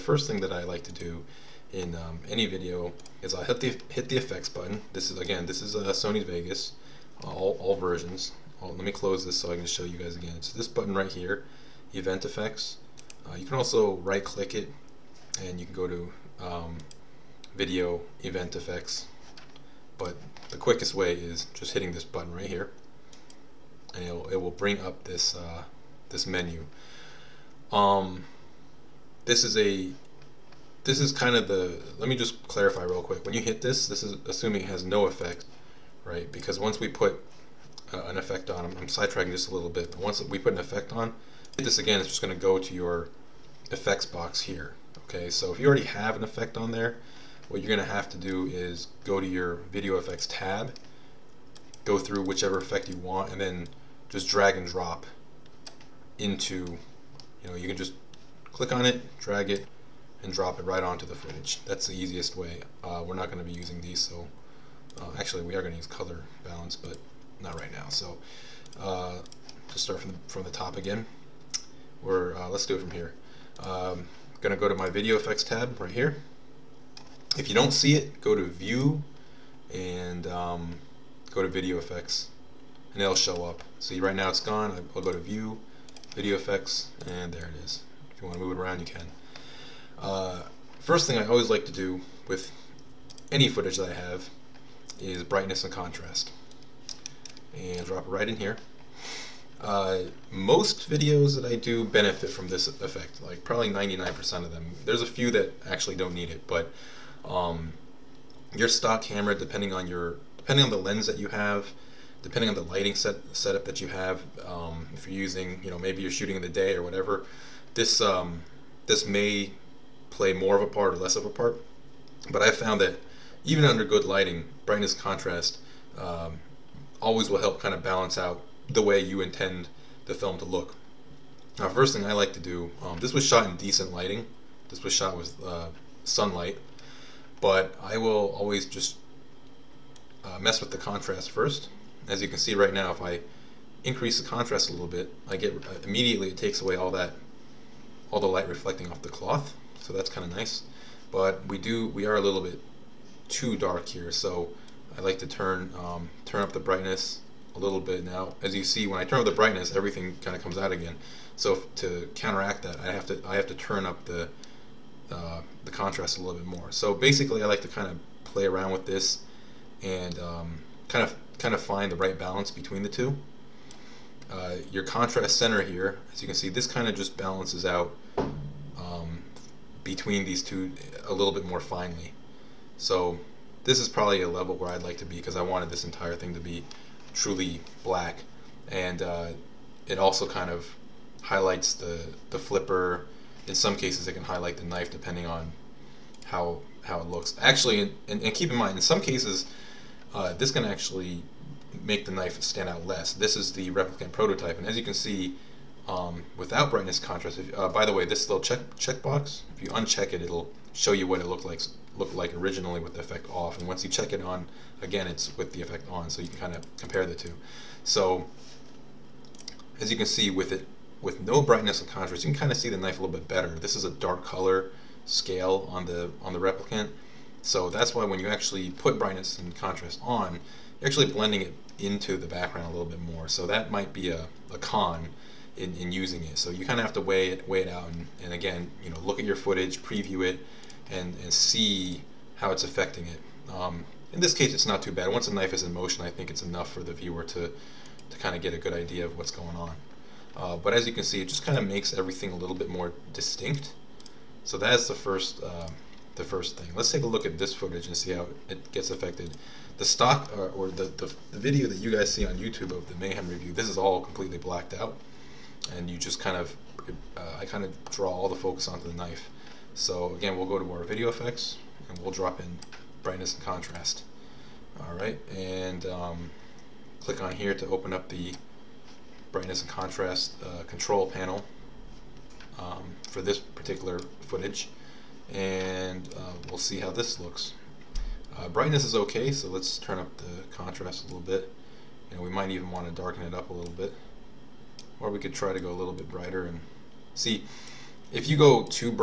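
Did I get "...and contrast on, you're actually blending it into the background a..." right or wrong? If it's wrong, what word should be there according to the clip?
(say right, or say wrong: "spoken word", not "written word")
right.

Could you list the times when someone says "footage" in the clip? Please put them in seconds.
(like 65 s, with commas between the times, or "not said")
61 s, 93 s, 239 s, 257 s, 284 s.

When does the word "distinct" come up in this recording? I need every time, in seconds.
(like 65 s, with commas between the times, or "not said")
253 s.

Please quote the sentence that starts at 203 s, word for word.
This is the replicant prototype, and as you can see, um, without brightness contrast.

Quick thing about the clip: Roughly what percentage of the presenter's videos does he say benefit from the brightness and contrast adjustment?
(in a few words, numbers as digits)
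99%.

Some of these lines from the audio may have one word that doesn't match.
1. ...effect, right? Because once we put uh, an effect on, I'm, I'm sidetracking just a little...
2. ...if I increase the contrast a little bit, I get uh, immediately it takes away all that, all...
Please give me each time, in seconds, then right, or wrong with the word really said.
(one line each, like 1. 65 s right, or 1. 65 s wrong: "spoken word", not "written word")
1. 35 s right
2. 142 s right.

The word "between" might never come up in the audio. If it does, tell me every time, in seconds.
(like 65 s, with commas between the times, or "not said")
172 s, 179 s.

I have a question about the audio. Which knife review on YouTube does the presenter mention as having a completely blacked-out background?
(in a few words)
Mayhem.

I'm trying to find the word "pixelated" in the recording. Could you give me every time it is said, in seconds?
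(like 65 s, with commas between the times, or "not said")
not said.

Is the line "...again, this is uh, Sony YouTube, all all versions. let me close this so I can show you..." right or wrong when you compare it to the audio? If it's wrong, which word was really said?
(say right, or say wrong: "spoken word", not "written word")
wrong: "Vegas", not "YouTube".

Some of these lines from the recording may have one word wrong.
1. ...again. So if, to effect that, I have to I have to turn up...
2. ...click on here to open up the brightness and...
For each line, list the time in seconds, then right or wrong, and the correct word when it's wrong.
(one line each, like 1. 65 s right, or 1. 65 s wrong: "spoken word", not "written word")
1. 160 s wrong: "counteract", not "effect"
2. 277 s right.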